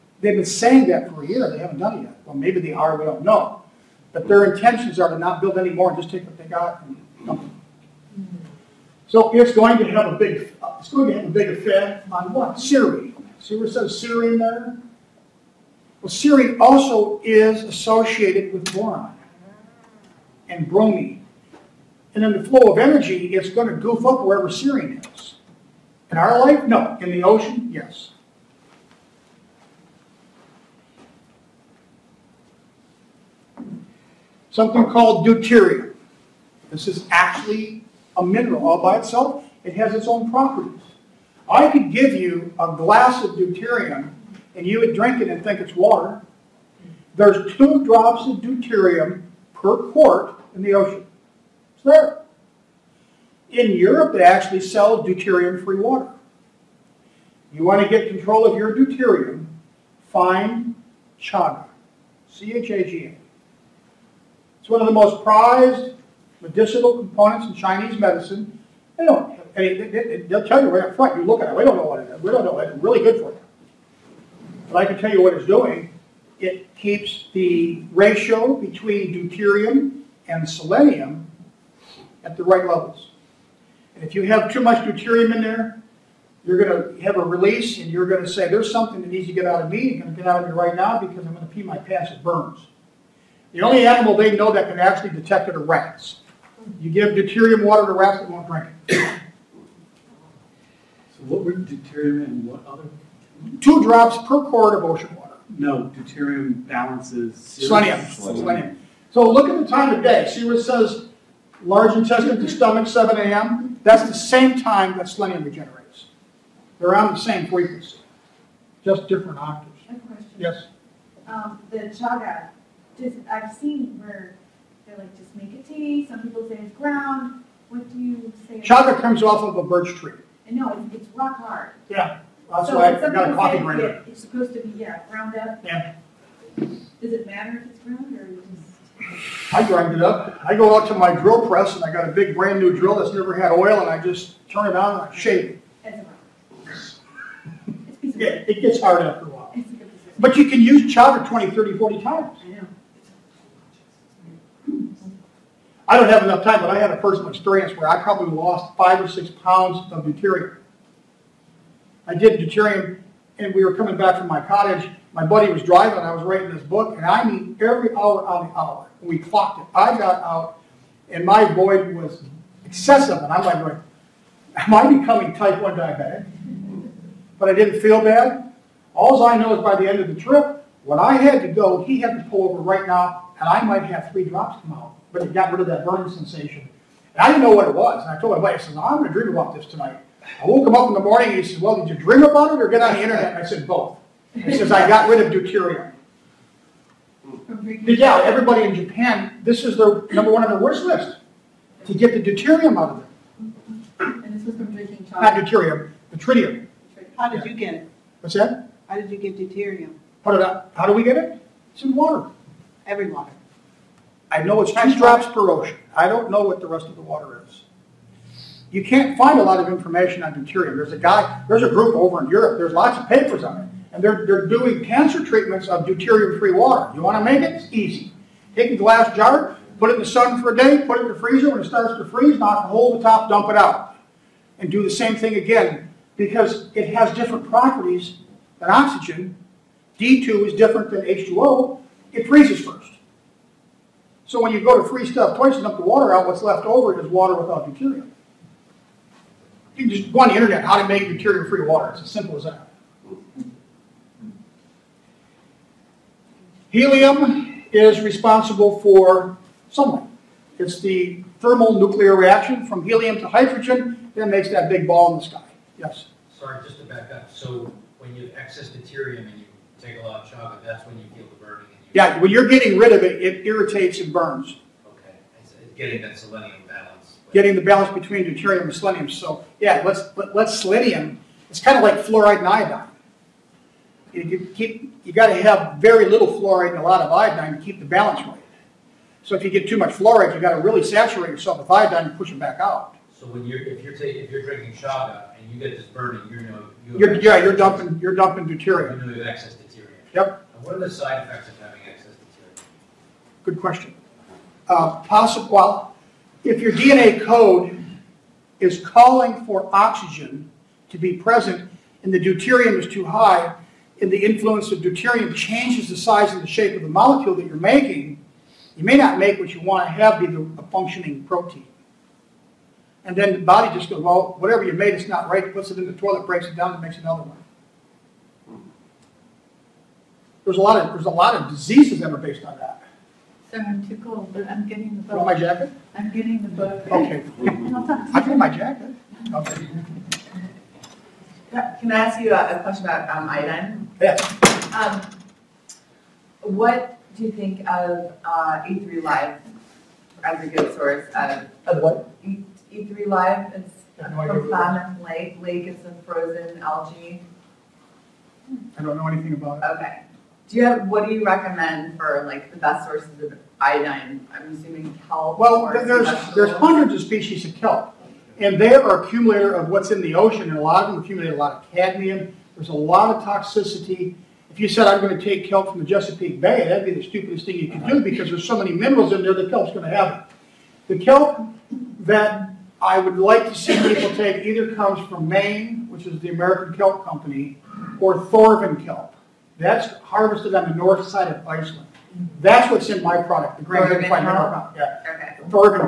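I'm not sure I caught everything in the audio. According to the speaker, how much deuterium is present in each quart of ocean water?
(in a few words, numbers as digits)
2 drops.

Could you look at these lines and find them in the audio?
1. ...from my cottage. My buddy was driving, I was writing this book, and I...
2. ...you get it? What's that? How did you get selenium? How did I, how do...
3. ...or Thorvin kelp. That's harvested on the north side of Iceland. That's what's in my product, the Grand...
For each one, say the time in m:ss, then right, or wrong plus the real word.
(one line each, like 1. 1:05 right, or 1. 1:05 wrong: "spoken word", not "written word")
1. 2:44 right
2. 3:27 wrong: "deuterium", not "selenium"
3. 6:27 right.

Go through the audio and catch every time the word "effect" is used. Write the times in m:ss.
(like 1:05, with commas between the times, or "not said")
0:11, 5:01.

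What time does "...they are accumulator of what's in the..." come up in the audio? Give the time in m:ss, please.
6:08.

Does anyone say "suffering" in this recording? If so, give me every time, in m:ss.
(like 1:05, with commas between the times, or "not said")
not said.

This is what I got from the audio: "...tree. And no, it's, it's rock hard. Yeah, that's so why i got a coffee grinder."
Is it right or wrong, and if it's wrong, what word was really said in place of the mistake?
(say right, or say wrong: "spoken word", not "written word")
right.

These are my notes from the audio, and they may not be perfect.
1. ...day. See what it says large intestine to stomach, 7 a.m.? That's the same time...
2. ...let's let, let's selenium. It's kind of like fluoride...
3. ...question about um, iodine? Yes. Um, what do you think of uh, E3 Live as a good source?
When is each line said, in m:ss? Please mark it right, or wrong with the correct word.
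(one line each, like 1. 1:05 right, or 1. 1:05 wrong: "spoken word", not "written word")
1. 1:50 right
2. 4:39 right
3. 5:42 right.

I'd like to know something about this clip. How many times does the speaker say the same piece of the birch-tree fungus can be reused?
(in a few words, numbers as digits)
20 to 40 times.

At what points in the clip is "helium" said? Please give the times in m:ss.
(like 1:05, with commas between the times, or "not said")
4:16, 4:22.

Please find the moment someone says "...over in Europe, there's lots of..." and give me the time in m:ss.
3:41.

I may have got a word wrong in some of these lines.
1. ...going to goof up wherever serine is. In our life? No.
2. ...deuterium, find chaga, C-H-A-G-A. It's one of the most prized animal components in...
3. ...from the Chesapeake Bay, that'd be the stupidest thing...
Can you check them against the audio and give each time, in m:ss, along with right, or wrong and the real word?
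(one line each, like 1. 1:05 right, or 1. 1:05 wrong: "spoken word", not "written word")
1. 0:23 right
2. 0:58 wrong: "medicinal", not "animal"
3. 6:15 right.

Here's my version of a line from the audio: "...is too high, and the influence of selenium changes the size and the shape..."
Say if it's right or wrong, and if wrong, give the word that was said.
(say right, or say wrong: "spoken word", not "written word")
wrong: "deuterium", not "selenium".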